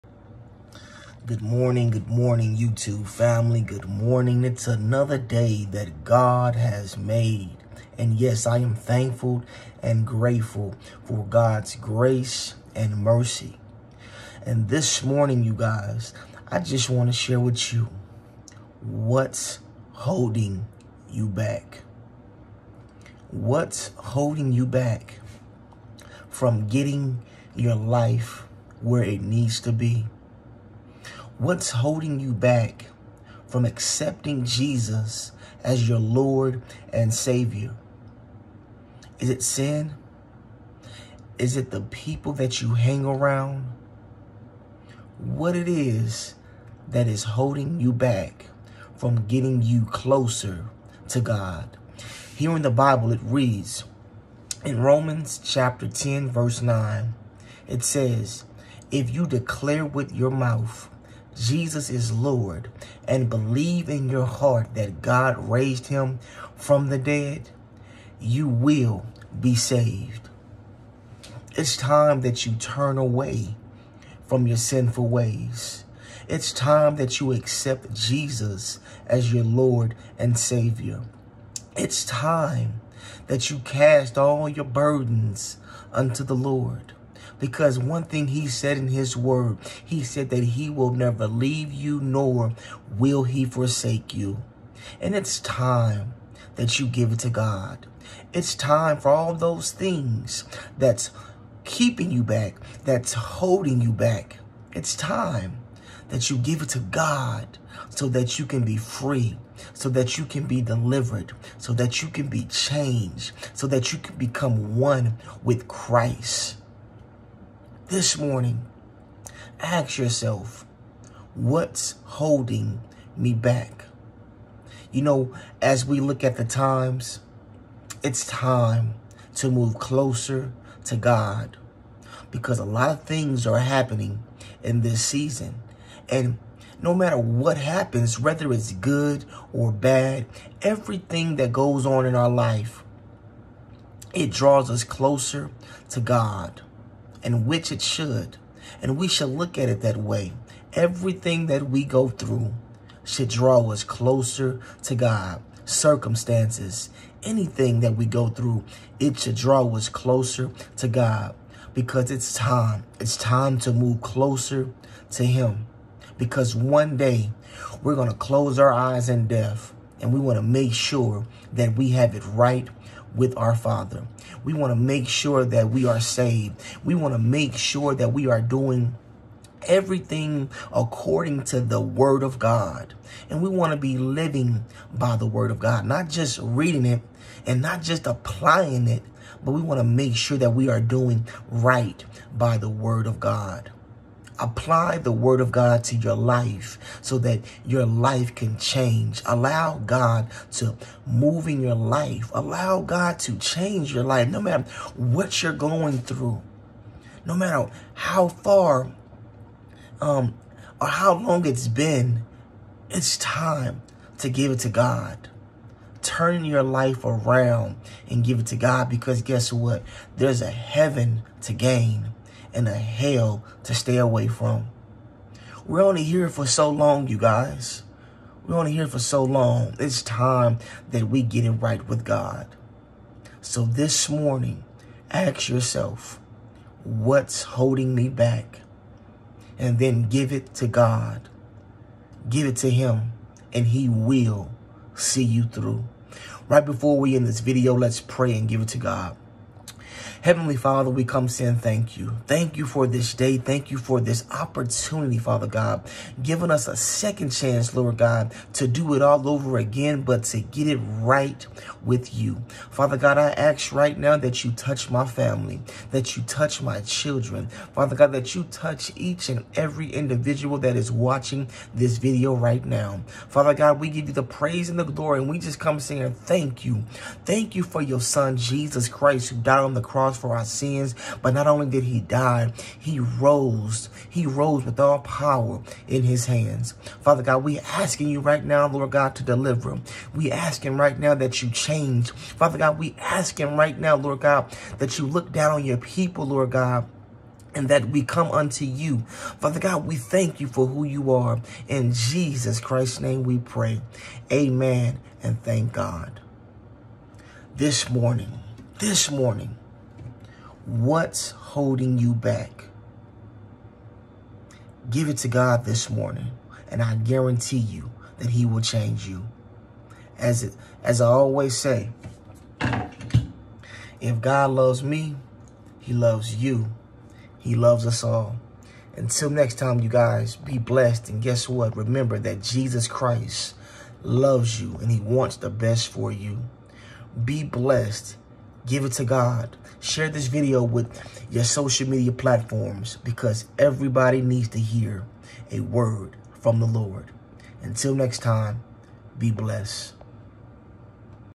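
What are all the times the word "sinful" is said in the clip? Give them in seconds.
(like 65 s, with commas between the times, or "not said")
74 s.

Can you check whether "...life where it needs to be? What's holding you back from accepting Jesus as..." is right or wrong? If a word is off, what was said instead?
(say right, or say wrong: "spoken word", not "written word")
right.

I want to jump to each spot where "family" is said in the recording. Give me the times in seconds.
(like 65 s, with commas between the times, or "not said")
3 s, 265 s.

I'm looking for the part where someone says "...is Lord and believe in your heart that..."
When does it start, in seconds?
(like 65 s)
61 s.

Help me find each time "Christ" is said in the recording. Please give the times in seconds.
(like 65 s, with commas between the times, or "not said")
115 s, 278 s, 302 s, 332 s.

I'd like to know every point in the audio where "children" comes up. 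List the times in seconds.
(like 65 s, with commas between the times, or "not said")
266 s.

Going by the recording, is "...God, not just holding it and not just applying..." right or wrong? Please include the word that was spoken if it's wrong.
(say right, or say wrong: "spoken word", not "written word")
wrong: "reading", not "holding".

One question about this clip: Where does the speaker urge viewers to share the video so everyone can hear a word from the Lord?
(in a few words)
social media platforms.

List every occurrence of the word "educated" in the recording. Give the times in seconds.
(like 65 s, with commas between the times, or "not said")
not said.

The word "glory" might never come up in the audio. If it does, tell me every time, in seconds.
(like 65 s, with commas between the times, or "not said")
274 s.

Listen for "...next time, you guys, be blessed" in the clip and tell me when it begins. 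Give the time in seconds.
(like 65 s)
329 s.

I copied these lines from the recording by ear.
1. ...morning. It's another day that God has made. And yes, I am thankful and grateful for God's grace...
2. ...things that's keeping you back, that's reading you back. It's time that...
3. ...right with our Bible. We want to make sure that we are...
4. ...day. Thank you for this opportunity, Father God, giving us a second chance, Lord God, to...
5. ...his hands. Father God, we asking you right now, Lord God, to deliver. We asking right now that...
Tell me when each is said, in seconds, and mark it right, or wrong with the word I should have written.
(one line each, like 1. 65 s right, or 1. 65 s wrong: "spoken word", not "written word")
1. 3 s right
2. 99 s wrong: "holding", not "reading"
3. 172 s wrong: "Father", not "Bible"
4. 253 s right
5. 286 s right.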